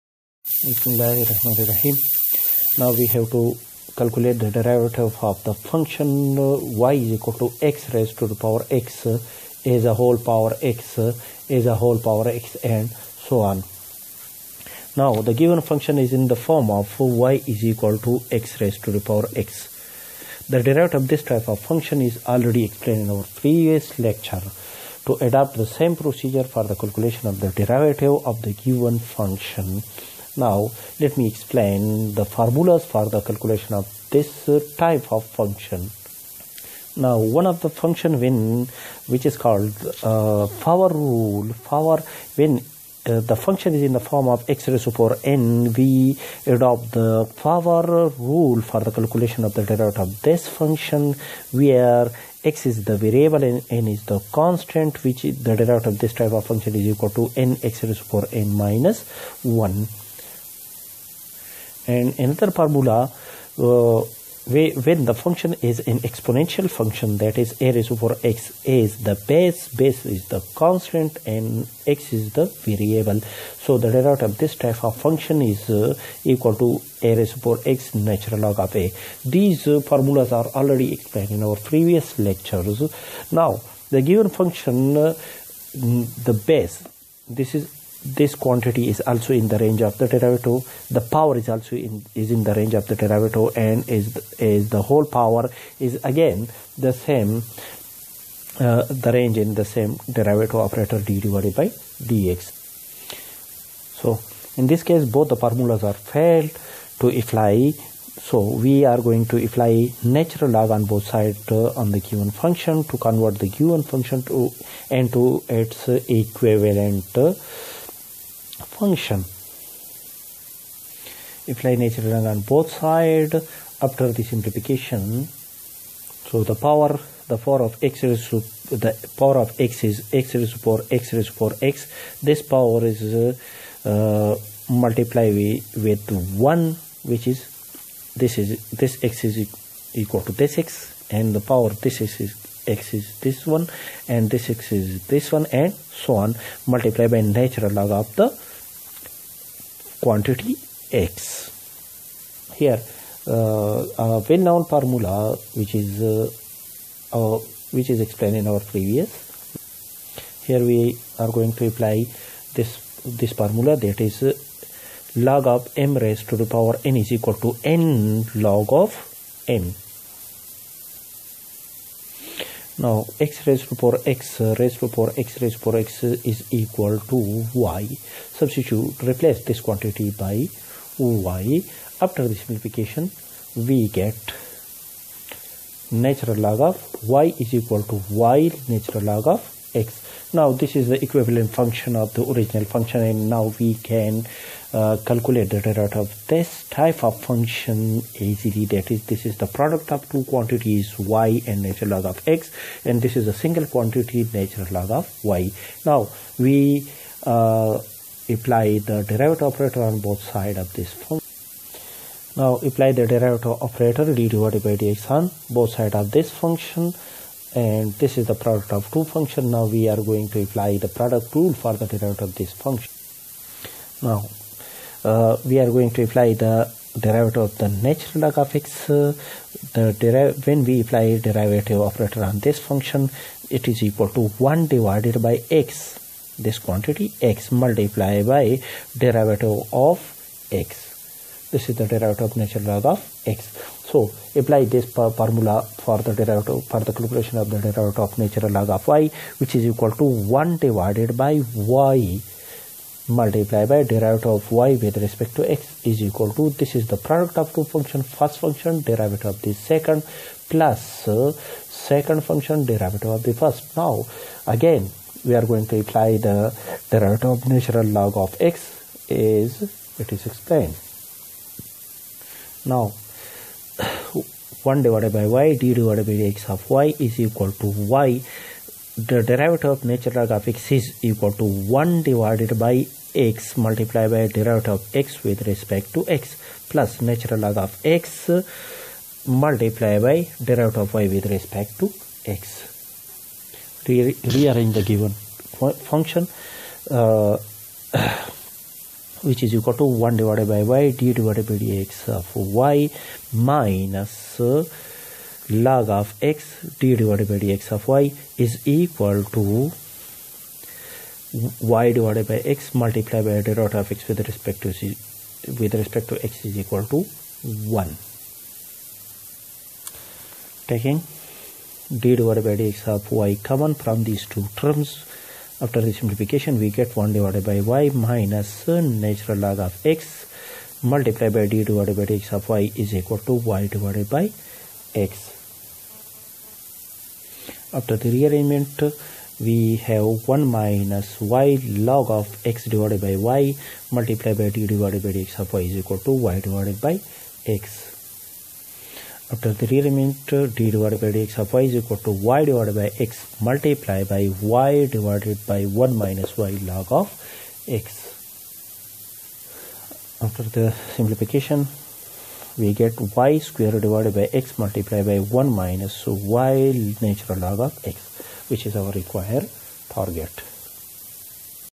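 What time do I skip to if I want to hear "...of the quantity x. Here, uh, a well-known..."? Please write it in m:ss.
2:27.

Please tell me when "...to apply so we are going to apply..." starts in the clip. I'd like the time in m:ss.
1:46.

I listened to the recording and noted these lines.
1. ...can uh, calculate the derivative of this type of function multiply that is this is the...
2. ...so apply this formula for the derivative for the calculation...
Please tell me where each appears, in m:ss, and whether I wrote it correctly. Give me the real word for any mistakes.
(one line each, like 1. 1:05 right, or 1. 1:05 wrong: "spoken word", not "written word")
1. 3:13 wrong: "easily", not "multiply"
2. 4:03 right.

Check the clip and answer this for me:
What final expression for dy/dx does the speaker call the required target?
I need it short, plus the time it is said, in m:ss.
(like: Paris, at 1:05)
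y^2 / (x(1 - y ln x)), at 6:03.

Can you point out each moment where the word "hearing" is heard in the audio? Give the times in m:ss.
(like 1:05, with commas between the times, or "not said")
not said.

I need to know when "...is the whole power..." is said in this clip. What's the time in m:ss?
1:34.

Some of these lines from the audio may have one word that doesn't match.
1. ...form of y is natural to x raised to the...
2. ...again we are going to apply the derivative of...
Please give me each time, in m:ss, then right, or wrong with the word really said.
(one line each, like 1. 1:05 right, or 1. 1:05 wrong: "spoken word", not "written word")
1. 0:16 wrong: "equal", not "natural"
2. 4:24 right.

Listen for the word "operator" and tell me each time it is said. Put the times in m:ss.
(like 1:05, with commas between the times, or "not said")
1:40, 3:29, 3:33, 3:51.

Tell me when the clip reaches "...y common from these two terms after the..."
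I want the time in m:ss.
5:23.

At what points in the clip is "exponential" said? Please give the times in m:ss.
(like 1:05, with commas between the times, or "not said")
1:05.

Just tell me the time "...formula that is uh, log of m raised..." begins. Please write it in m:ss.
2:43.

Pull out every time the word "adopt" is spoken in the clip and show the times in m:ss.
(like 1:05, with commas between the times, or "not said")
0:25, 0:46.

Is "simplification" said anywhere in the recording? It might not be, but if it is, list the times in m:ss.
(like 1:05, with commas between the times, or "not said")
2:04, 3:02, 5:25, 6:00.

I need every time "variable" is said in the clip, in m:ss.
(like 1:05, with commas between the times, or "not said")
0:52, 1:12.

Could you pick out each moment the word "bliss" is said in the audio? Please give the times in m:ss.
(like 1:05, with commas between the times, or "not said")
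not said.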